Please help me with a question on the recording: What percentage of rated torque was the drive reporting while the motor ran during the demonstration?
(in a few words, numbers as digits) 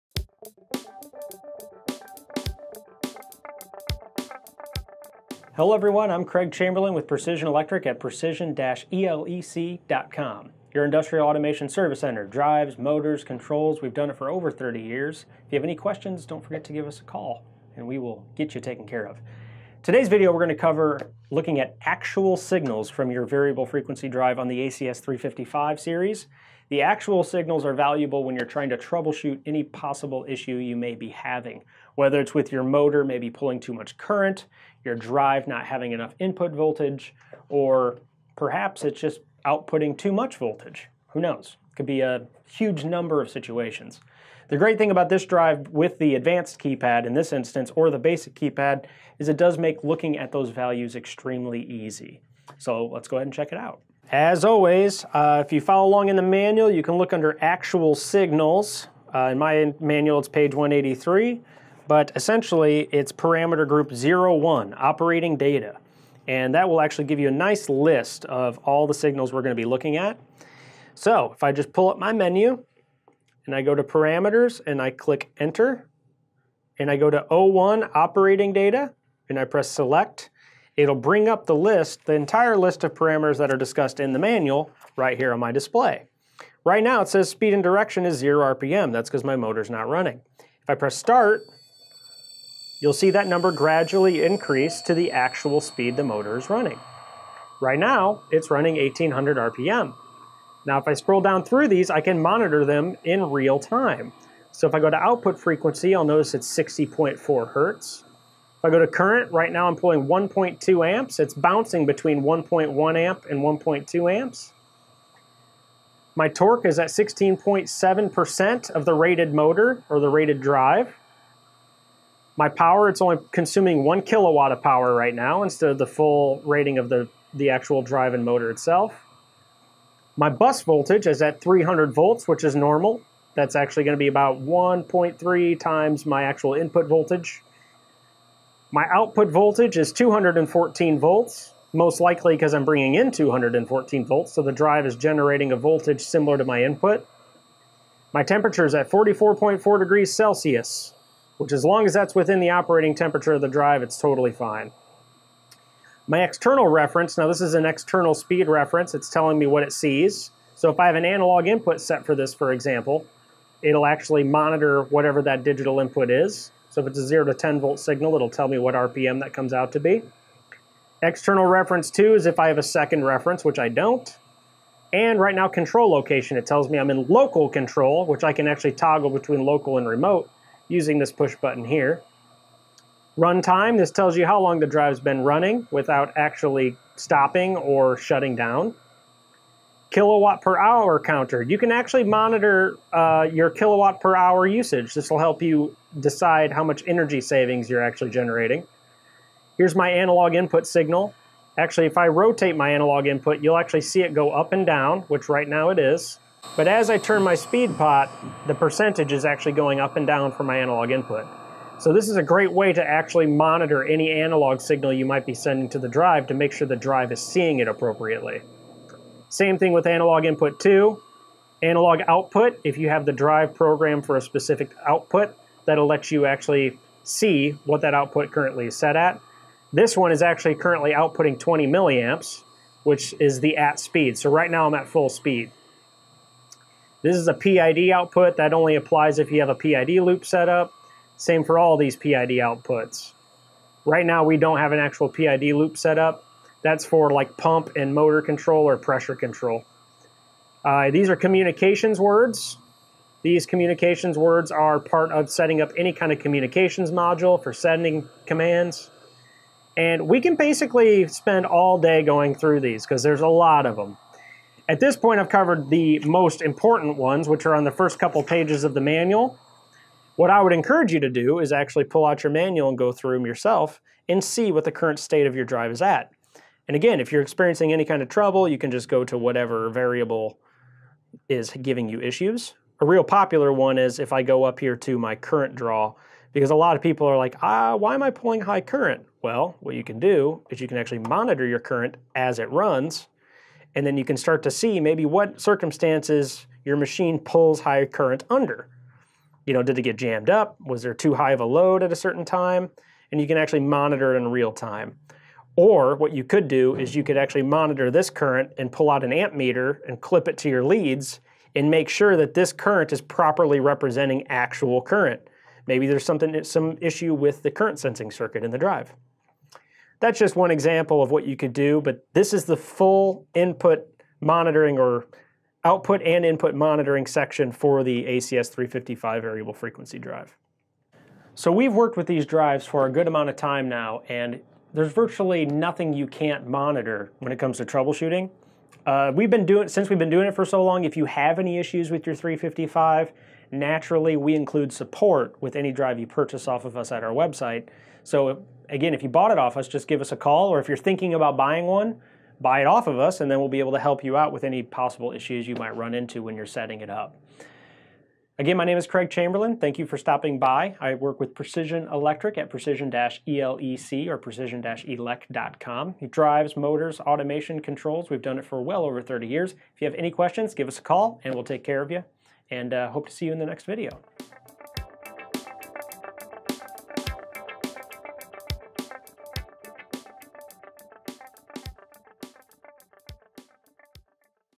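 16.7%.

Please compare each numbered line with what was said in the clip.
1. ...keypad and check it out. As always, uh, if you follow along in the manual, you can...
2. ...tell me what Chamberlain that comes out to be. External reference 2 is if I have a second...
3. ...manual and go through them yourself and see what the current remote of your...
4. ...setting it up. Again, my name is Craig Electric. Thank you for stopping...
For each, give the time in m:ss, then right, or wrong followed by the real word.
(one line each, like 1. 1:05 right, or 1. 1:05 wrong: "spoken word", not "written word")
1. 0:53 wrong: "ahead", not "keypad"
2. 2:48 wrong: "RPM", not "Chamberlain"
3. 4:32 wrong: "state", not "remote"
4. 5:56 wrong: "Chamberlain", not "Electric".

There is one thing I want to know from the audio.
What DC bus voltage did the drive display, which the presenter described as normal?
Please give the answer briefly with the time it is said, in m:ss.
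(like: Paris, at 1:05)
300 volts, at 2:11.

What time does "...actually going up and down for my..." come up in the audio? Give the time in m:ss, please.
3:29.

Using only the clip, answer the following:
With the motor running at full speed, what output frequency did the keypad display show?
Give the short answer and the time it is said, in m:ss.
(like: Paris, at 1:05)
60.4 hertz, at 1:46.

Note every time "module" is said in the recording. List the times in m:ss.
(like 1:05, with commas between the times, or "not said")
4:16.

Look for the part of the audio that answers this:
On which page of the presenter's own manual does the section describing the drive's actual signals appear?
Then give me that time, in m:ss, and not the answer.
1:00.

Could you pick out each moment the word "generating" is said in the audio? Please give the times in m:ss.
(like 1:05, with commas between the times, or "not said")
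2:24, 3:18.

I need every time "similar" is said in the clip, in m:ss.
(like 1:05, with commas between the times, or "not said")
2:26.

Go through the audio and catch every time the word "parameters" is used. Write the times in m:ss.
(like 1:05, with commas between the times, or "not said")
1:03, 1:13, 1:22.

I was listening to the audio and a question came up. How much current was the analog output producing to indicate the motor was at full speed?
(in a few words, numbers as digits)
20 milliamps.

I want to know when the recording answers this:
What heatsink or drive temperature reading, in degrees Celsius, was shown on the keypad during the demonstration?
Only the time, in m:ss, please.
2:28.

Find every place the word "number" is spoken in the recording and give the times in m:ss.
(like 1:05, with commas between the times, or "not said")
0:42, 1:33.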